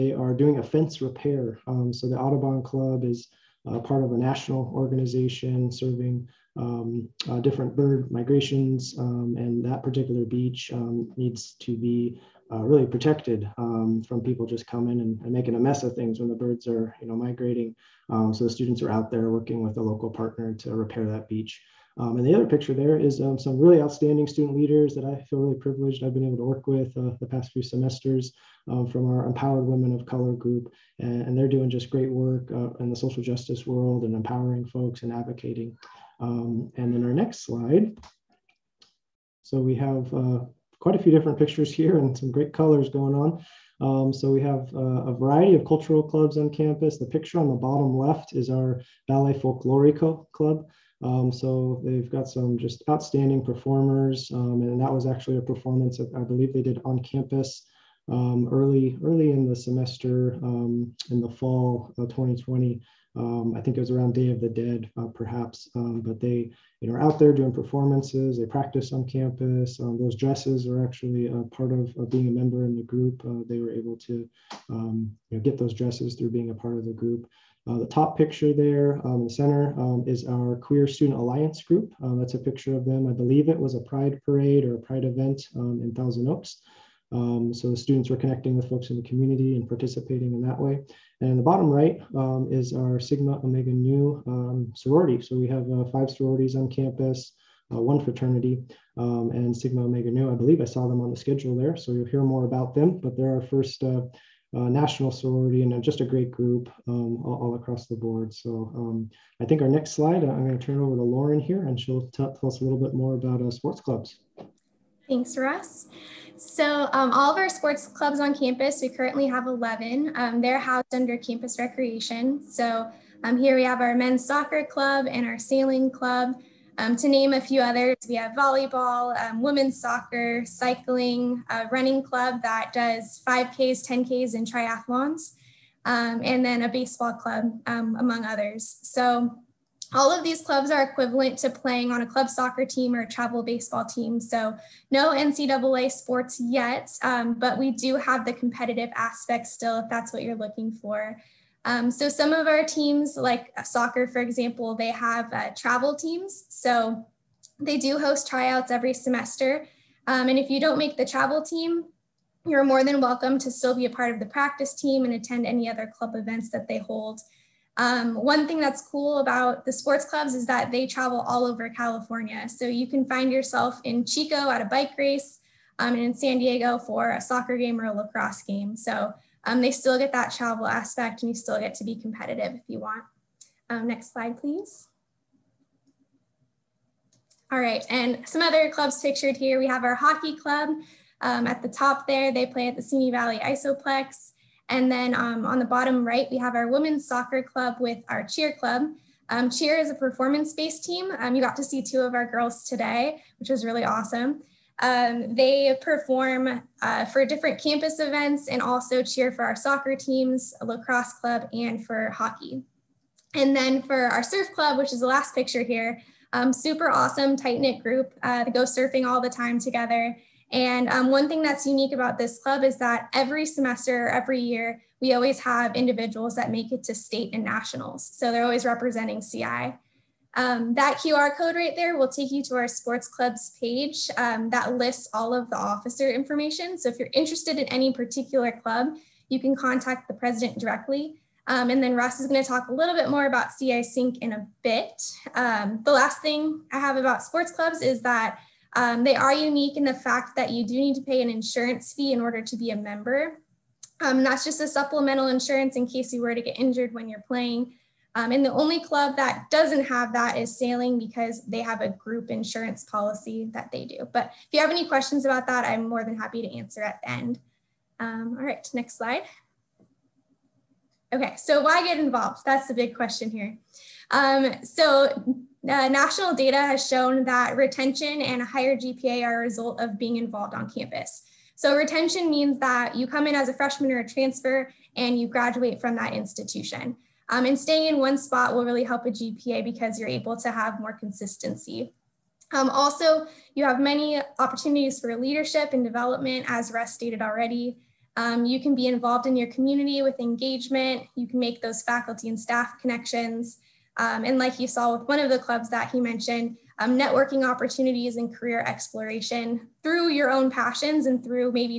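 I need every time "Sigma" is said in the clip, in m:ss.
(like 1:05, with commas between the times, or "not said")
1:32, 1:39.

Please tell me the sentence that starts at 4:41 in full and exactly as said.
So retention means that you come in as a freshman or a transfer and you graduate from that institution.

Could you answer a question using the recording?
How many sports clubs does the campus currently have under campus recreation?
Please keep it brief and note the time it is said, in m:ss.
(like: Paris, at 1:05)
11, at 1:59.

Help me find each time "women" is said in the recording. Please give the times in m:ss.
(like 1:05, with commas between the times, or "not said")
0:29, 2:09, 3:16.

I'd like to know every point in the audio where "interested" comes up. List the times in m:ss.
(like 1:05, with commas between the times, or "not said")
3:57.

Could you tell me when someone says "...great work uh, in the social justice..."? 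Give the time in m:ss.
0:31.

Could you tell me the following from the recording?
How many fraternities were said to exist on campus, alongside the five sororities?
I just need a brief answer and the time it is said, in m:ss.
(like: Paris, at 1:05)
1, at 1:37.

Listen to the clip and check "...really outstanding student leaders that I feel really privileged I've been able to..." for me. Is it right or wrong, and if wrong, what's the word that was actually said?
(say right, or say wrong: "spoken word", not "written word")
right.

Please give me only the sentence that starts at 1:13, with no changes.
Uh, they were able to you know, get those dresses through being a part of the group.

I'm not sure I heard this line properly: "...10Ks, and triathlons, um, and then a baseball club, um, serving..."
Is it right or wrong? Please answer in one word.
wrong.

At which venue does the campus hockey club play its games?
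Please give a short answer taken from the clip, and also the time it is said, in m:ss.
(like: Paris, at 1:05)
Simi Valley Iceoplex, at 3:12.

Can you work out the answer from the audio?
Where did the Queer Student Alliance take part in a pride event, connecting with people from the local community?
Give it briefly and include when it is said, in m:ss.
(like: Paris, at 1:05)
Thousand Oaks, at 1:25.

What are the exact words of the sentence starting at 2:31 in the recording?
Um, so some of our teams, like soccer, for example, they have uh, travel teams.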